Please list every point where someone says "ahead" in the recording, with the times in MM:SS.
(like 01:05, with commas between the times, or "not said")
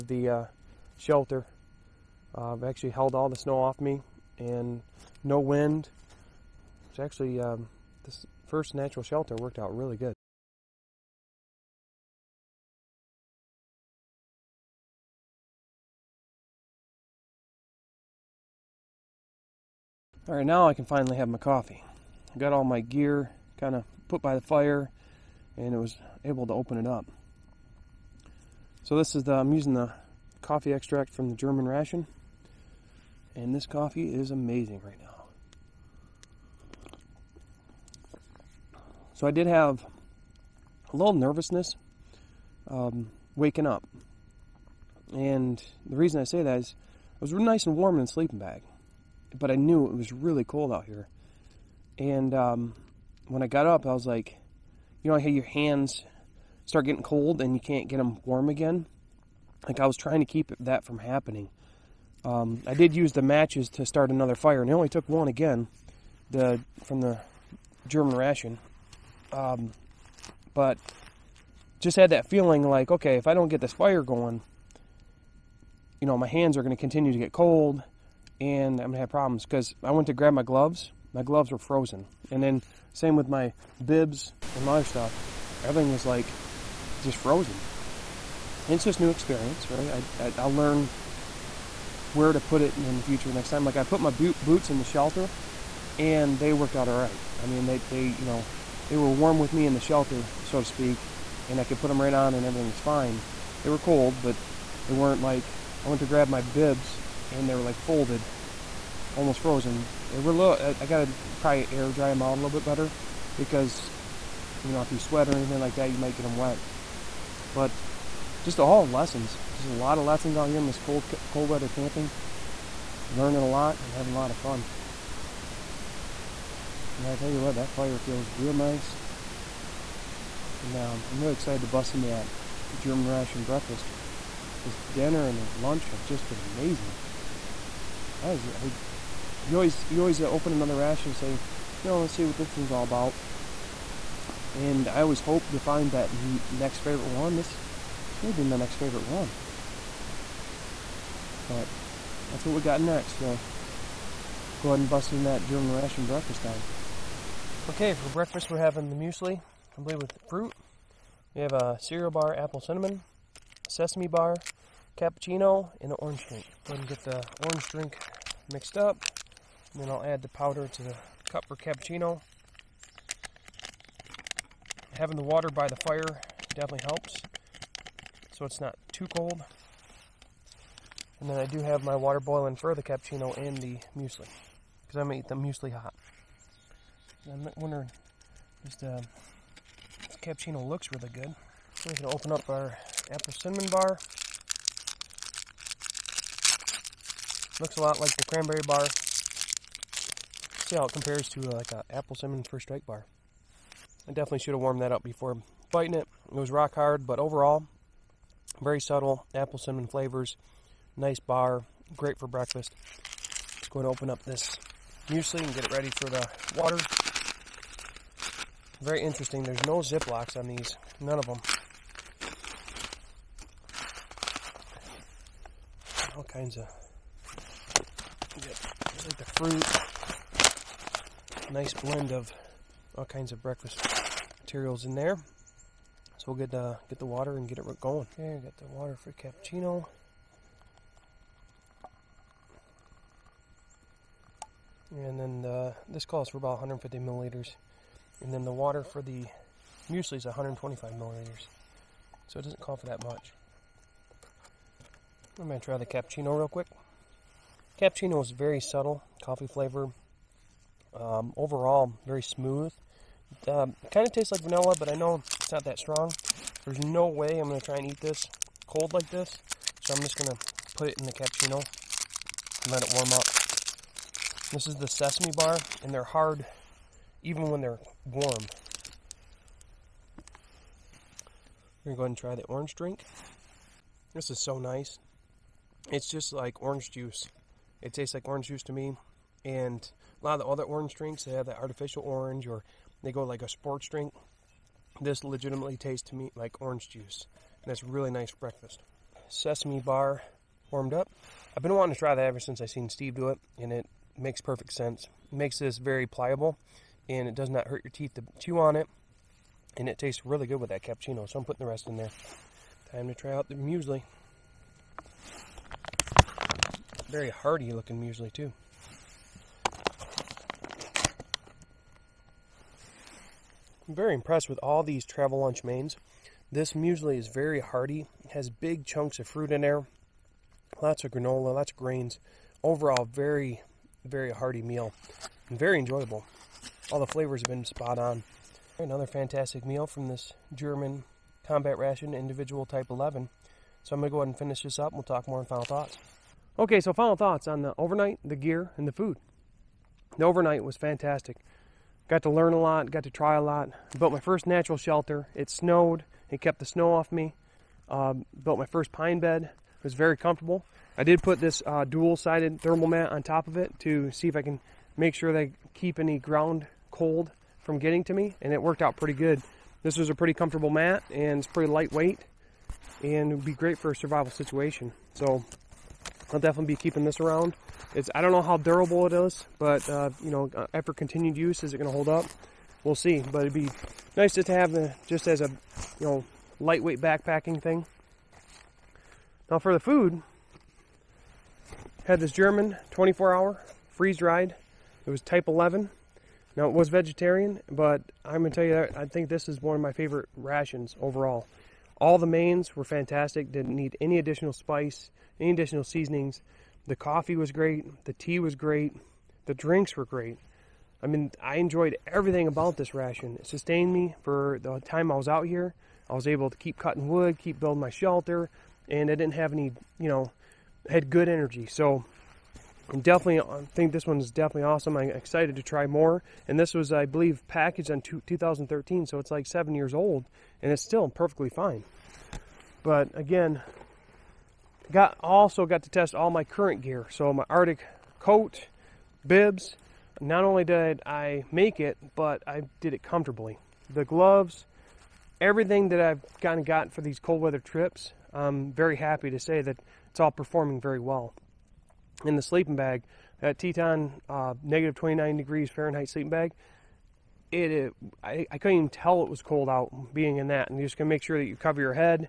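02:34, 02:46, 04:42, 05:44.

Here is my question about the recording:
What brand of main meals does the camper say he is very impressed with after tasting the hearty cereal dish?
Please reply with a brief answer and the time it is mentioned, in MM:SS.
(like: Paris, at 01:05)
Travellunch, at 05:25.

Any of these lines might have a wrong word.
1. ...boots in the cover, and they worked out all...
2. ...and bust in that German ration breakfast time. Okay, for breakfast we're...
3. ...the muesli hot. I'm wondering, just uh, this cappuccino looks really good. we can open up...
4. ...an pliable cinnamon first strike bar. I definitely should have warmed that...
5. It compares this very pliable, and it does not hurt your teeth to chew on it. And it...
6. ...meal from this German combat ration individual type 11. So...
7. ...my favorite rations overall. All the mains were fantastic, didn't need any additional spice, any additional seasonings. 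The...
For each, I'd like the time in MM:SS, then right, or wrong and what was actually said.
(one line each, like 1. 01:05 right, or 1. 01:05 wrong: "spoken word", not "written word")
1. 01:34 wrong: "shelter", not "cover"
2. 02:34 right
3. 03:05 right
4. 03:21 wrong: "apple", not "pliable"
5. 05:05 wrong: "makes", not "compares"
6. 05:39 right
7. 06:39 right.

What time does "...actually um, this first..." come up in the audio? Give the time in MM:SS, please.
00:06.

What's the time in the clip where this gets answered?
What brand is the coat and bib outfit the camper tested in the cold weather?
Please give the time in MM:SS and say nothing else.
07:17.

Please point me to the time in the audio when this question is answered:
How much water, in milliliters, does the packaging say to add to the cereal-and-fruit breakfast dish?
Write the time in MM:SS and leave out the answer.
04:10.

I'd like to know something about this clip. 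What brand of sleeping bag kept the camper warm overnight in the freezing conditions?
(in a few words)
Teton.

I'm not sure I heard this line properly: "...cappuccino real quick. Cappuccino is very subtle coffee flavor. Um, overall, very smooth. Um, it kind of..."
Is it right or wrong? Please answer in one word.
right.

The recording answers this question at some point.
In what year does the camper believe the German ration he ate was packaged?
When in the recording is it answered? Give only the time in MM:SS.
07:08.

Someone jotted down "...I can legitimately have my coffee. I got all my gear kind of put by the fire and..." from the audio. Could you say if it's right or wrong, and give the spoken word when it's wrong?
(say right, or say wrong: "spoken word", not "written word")
wrong: "finally", not "legitimately".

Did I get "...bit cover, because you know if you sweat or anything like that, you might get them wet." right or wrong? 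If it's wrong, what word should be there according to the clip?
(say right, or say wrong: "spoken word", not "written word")
wrong: "better", not "cover".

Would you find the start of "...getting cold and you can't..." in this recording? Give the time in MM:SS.
00:56.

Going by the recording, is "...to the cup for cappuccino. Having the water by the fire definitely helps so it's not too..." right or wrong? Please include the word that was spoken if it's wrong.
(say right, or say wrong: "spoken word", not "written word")
right.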